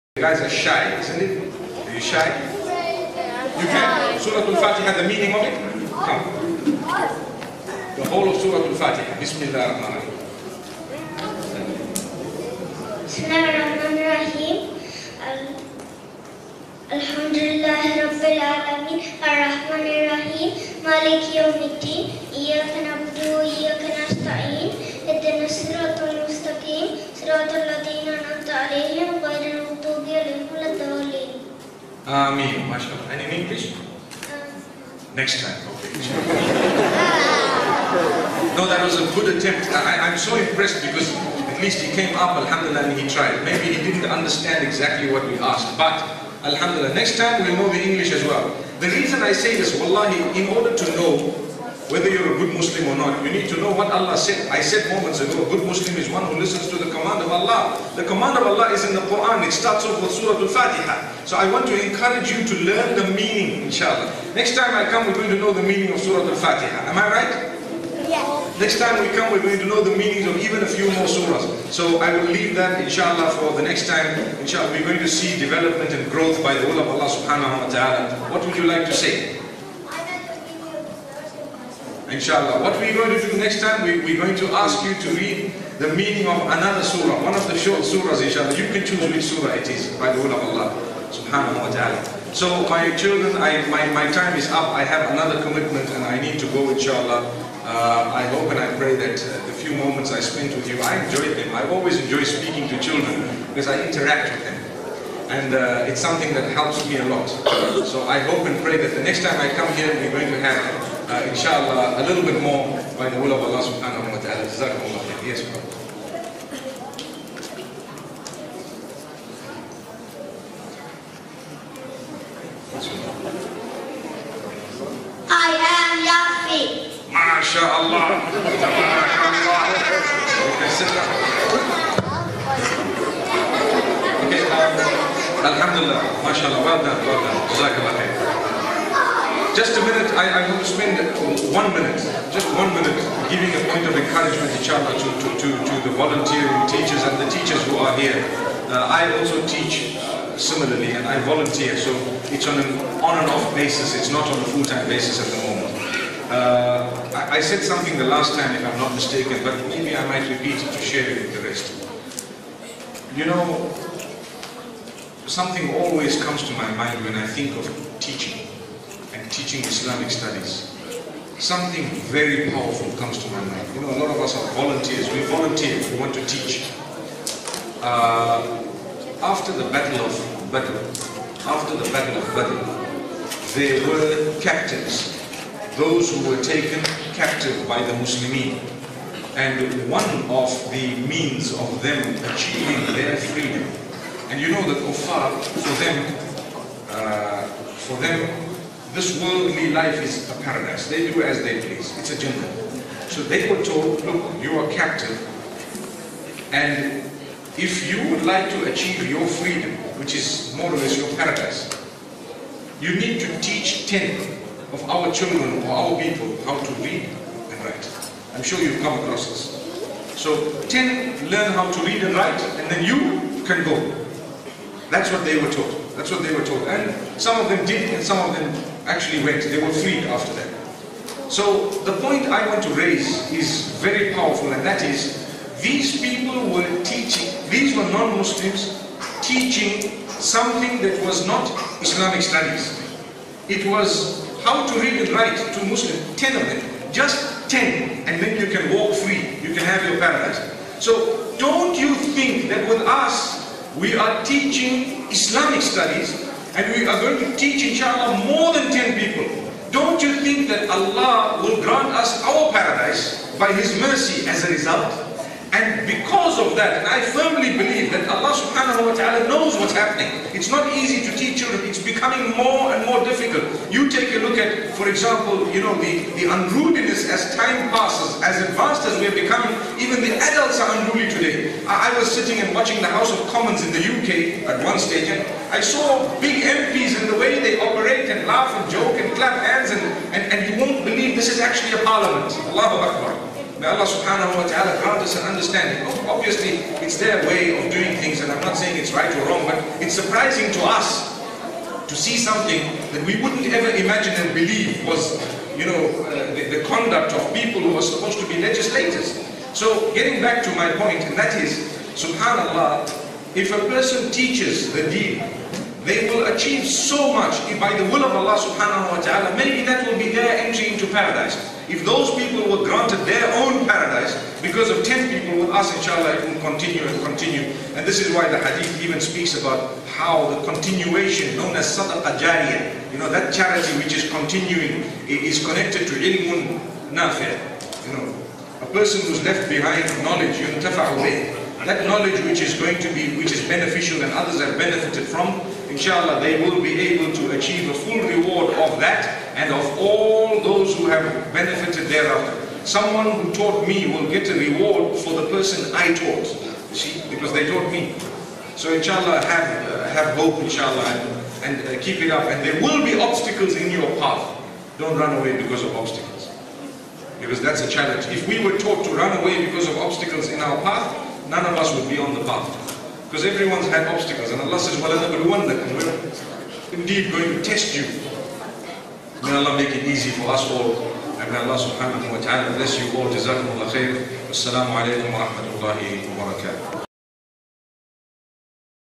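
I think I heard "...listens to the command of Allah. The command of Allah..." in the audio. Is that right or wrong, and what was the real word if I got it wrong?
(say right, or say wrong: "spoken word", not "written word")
right.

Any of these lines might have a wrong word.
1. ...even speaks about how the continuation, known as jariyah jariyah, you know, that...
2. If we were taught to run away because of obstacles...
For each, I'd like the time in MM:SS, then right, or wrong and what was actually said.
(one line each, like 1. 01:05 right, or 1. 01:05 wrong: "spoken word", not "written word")
1. 05:28 wrong: "sadaqah", not "jariyah"
2. 06:08 right.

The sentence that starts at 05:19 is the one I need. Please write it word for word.
Maybe that will be their entry into paradise.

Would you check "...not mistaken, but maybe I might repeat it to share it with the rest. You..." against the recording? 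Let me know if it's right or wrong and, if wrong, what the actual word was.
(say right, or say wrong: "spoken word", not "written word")
right.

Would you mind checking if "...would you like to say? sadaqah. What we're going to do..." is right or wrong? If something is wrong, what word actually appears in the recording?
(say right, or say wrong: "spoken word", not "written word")
wrong: "inshallah", not "sadaqah".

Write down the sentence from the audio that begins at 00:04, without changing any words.
Surah Al-Fatiha, the meaning of it?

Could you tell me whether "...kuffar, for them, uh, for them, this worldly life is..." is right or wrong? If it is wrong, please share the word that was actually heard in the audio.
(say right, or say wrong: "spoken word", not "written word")
right.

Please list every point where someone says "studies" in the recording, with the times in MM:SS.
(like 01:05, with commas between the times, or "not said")
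02:50, 04:02, 04:15.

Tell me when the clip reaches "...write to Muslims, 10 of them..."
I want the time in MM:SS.
04:05.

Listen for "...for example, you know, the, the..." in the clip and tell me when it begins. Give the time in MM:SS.
04:34.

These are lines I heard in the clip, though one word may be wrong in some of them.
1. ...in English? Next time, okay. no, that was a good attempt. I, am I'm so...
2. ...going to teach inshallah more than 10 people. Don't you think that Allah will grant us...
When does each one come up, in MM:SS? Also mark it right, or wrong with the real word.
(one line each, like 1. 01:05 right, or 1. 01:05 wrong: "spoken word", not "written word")
1. 00:33 right
2. 04:16 right.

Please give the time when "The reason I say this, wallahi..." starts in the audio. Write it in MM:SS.
00:48.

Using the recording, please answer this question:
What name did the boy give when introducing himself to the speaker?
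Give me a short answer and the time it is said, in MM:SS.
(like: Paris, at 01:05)
Yafi, at 02:06.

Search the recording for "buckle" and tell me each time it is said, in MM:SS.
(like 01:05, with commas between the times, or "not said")
not said.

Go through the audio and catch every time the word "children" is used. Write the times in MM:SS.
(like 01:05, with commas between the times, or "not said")
01:32, 01:42, 03:35, 04:31.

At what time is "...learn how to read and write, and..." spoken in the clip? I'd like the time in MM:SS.
03:41.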